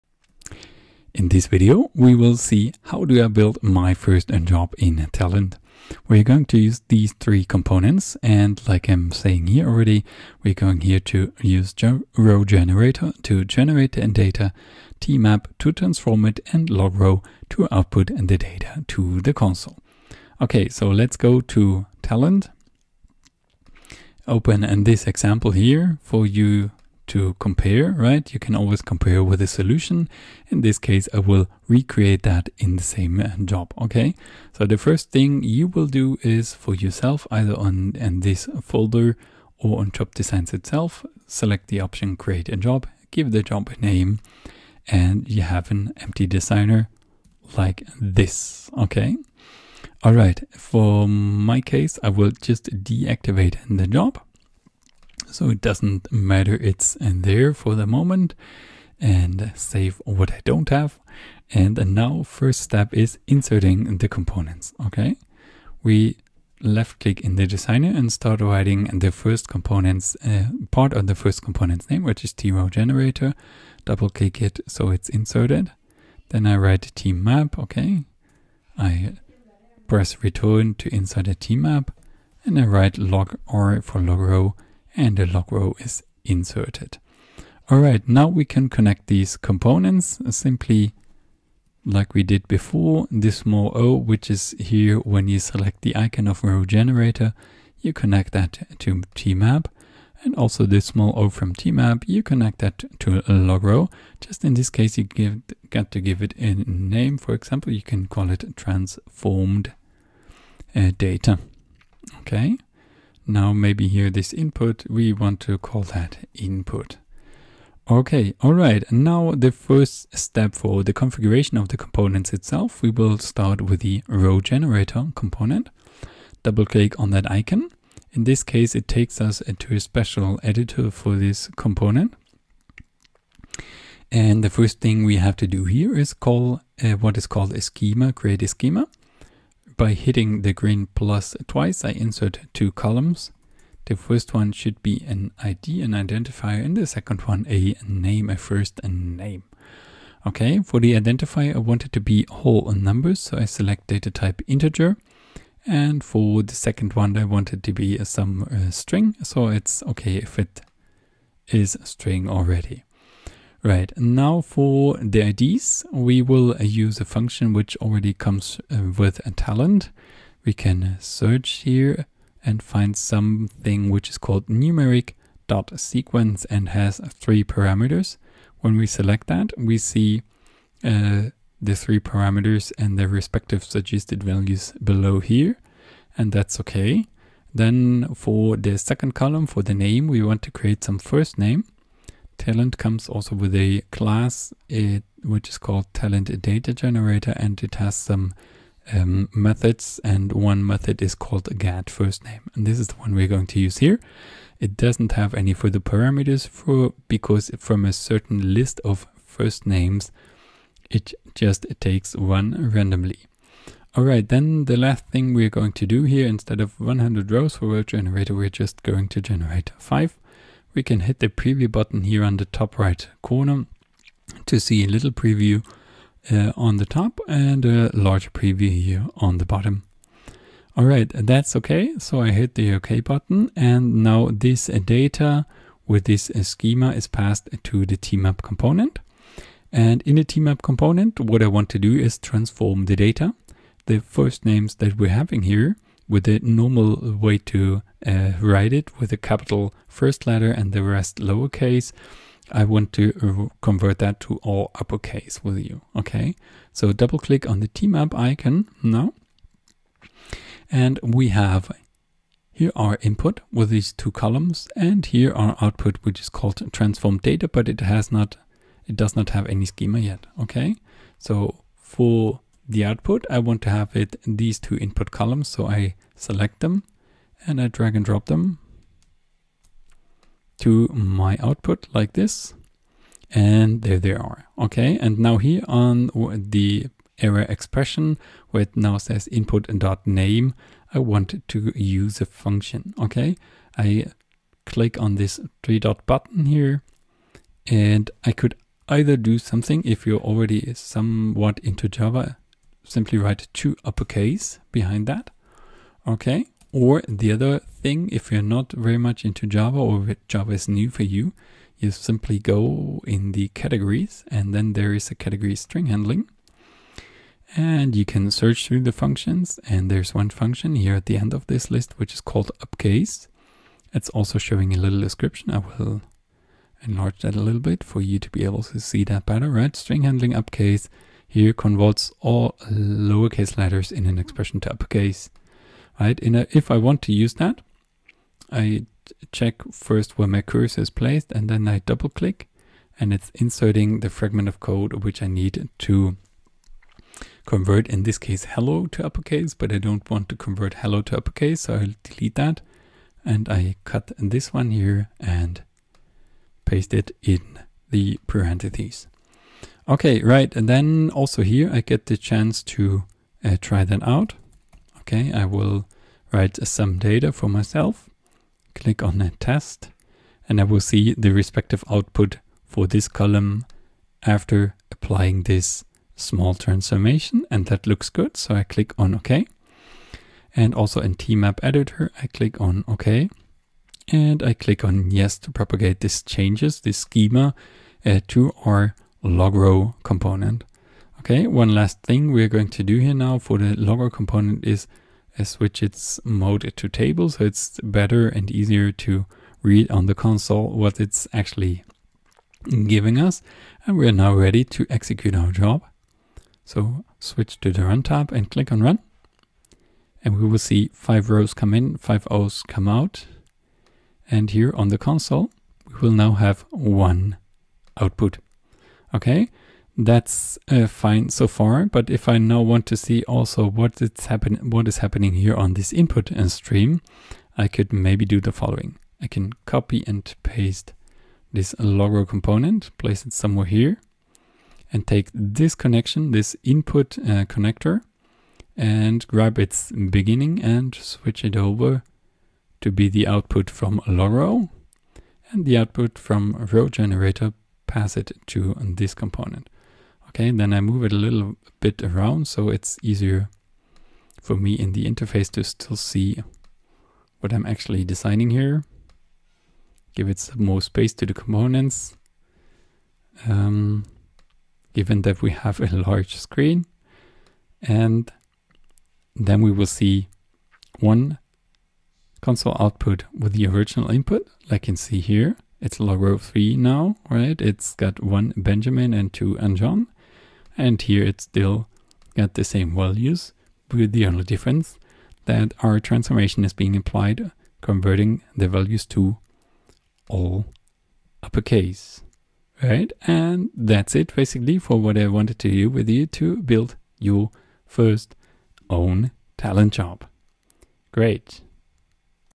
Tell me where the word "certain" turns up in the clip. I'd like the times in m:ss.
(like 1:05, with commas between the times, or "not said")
3:27.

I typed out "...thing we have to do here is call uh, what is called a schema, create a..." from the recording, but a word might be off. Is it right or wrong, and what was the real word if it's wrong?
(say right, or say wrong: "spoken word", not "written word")
right.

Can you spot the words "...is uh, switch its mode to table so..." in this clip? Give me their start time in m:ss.
6:34.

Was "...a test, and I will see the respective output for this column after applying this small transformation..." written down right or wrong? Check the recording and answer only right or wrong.
right.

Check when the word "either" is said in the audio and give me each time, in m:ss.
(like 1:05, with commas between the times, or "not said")
0:37, 4:58.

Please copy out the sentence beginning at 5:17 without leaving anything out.
And you can search through the functions and there's one function here at the end of this list which is called upcase.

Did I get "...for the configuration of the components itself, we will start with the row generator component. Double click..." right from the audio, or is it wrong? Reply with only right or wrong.
right.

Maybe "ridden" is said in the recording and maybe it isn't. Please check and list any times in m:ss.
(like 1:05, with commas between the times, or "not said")
not said.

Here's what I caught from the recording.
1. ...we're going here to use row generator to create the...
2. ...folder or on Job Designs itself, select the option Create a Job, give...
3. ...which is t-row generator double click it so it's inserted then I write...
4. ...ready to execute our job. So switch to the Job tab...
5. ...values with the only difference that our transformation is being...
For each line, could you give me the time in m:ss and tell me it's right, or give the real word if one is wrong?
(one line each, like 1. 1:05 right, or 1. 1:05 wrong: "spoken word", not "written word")
1. 0:10 wrong: "generate", not "create"
2. 0:38 right
3. 1:12 right
4. 6:44 wrong: "Run", not "Job"
5. 8:02 right.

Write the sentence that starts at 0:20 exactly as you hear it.
Okay, so let's go to Talend.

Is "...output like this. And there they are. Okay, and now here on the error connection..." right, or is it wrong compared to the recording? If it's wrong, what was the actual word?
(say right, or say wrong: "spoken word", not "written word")
wrong: "expression", not "connection".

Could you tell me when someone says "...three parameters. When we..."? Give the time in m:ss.
2:57.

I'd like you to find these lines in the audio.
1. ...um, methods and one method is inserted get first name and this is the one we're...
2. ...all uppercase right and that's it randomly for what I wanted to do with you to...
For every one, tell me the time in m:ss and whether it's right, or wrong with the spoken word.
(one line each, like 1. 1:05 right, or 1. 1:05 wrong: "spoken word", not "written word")
1. 3:18 wrong: "called", not "inserted"
2. 8:10 wrong: "basically", not "randomly".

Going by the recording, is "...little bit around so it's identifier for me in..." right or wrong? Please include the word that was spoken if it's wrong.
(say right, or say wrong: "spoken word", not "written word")
wrong: "easier", not "identifier".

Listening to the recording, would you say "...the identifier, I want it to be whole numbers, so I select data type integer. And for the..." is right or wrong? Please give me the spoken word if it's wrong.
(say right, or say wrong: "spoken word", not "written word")
right.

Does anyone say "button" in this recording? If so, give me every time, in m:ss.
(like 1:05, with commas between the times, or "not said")
3:41, 3:53, 4:56.